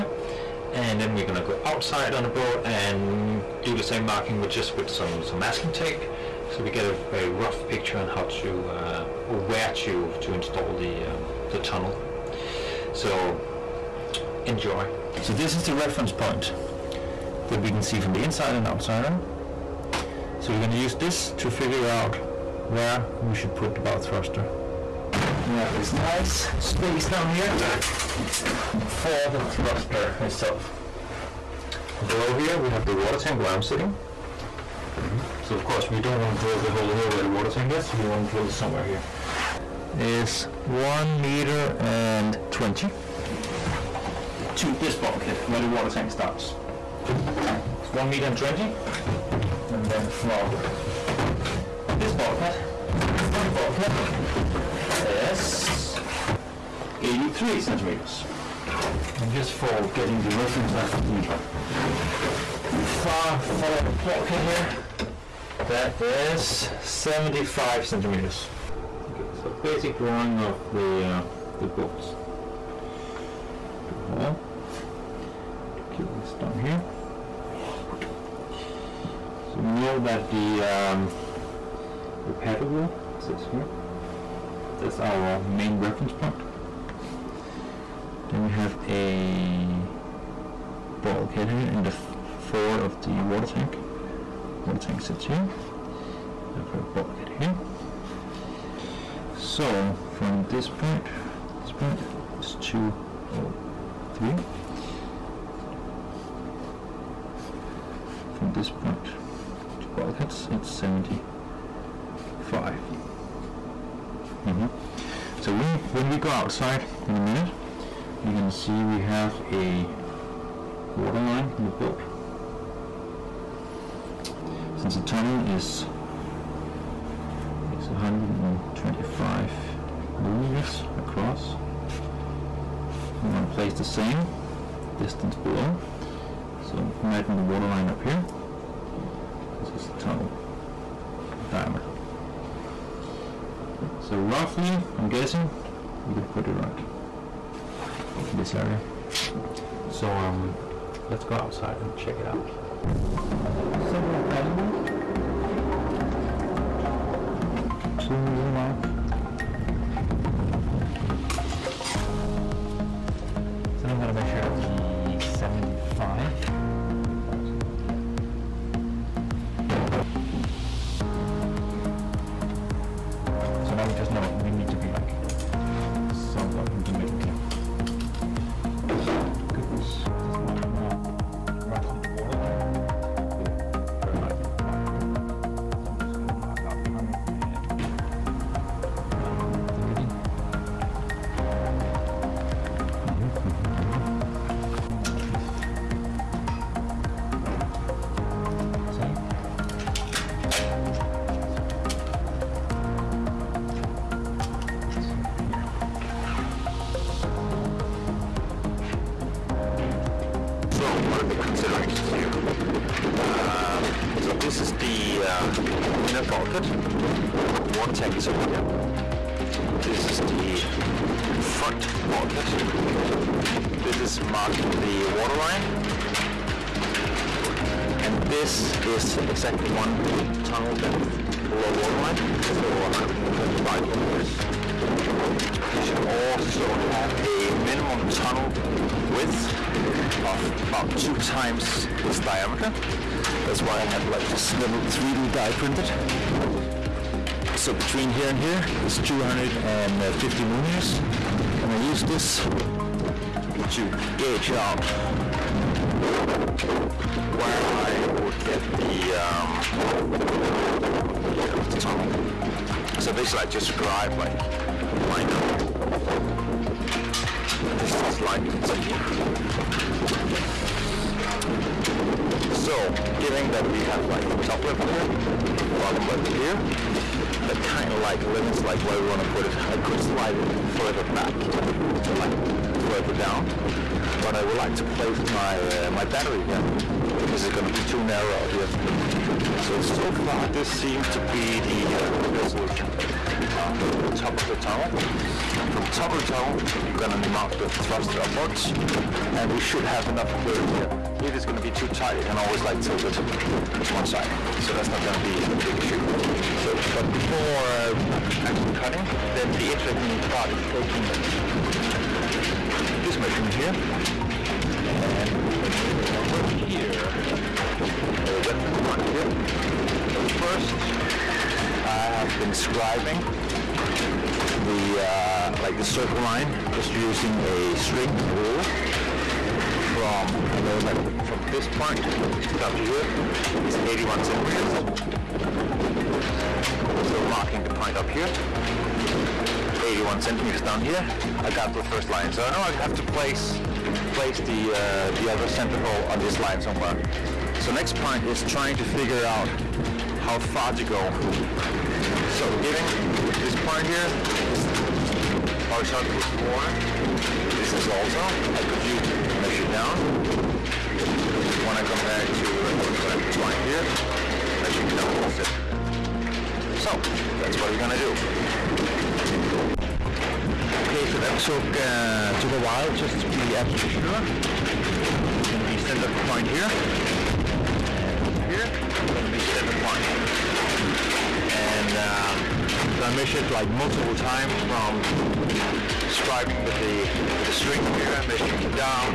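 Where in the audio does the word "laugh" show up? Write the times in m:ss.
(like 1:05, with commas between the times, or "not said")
not said.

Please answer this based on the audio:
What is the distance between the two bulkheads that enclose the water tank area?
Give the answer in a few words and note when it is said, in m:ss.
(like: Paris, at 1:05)
83 centimeters, at 0:57.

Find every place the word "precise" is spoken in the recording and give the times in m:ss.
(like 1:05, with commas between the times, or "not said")
not said.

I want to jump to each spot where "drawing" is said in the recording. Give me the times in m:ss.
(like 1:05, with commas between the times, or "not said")
1:09.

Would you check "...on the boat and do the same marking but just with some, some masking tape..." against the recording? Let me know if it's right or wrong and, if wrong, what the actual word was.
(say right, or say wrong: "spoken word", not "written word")
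right.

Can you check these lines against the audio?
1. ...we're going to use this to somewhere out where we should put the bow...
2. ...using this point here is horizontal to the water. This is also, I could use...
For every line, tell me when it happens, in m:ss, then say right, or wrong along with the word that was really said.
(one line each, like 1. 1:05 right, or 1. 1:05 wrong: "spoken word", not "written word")
1. 0:20 wrong: "figure", not "somewhere"
2. 5:52 wrong: "giving", not "using".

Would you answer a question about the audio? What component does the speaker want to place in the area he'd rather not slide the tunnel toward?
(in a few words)
battery.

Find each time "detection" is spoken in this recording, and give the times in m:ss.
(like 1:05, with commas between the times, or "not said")
not said.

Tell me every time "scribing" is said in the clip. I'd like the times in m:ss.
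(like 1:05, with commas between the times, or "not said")
5:22, 6:26.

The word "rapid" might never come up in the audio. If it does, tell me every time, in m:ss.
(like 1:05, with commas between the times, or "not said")
not said.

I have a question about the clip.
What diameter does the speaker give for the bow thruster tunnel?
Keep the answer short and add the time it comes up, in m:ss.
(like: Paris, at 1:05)
125 millimeters, at 2:07.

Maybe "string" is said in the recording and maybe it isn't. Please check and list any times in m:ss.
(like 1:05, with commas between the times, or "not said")
5:27, 6:27.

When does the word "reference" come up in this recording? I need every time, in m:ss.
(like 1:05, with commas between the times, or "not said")
0:15, 1:00, 1:25, 5:18.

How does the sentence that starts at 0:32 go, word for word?
Below here we have the water tank where I'm sitting.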